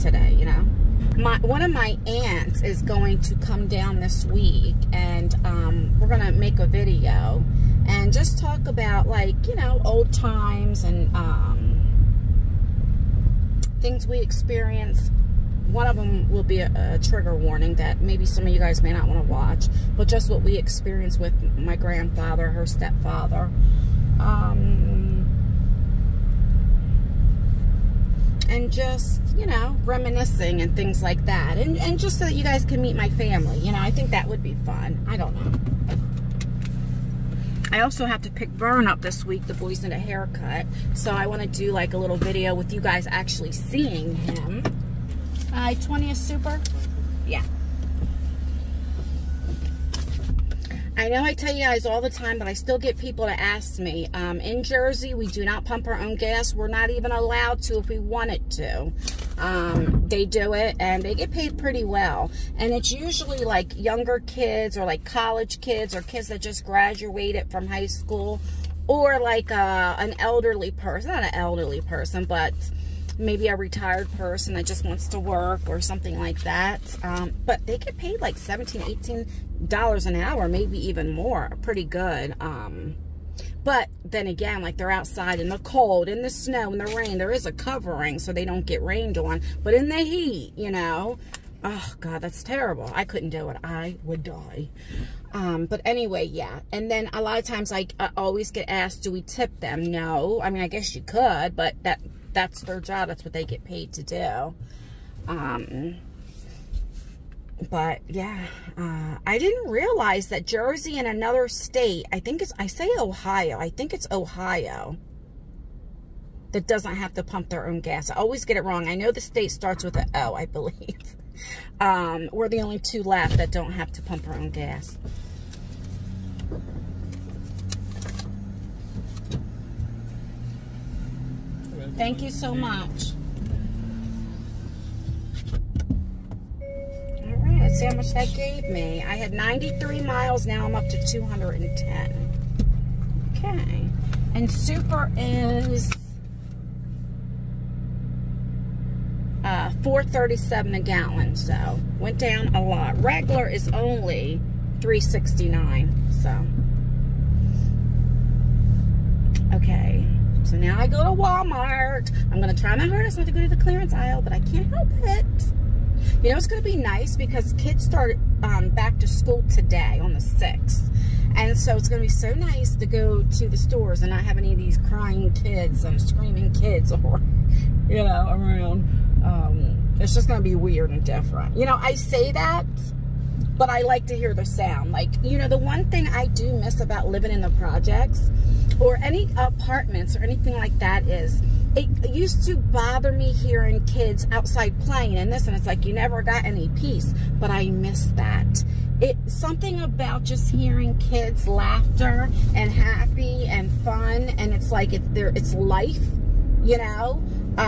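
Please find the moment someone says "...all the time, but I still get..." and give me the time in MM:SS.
00:51.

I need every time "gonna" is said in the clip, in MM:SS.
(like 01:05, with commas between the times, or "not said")
00:06, 02:42.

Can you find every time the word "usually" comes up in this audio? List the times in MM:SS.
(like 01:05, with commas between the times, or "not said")
01:02.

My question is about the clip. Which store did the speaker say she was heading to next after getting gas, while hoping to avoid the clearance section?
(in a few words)
Walmart.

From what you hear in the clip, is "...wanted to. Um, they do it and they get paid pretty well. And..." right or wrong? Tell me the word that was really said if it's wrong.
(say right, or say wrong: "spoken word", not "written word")
right.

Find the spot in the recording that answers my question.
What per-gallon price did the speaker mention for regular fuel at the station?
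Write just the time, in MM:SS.
02:34.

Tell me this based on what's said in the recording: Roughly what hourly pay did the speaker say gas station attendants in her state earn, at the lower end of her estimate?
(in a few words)
$17.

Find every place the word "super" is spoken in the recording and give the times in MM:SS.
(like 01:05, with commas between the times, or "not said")
00:46, 02:24.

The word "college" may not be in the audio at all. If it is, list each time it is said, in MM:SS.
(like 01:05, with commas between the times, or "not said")
01:05.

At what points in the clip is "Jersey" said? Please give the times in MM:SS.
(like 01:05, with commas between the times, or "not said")
00:54, 01:50.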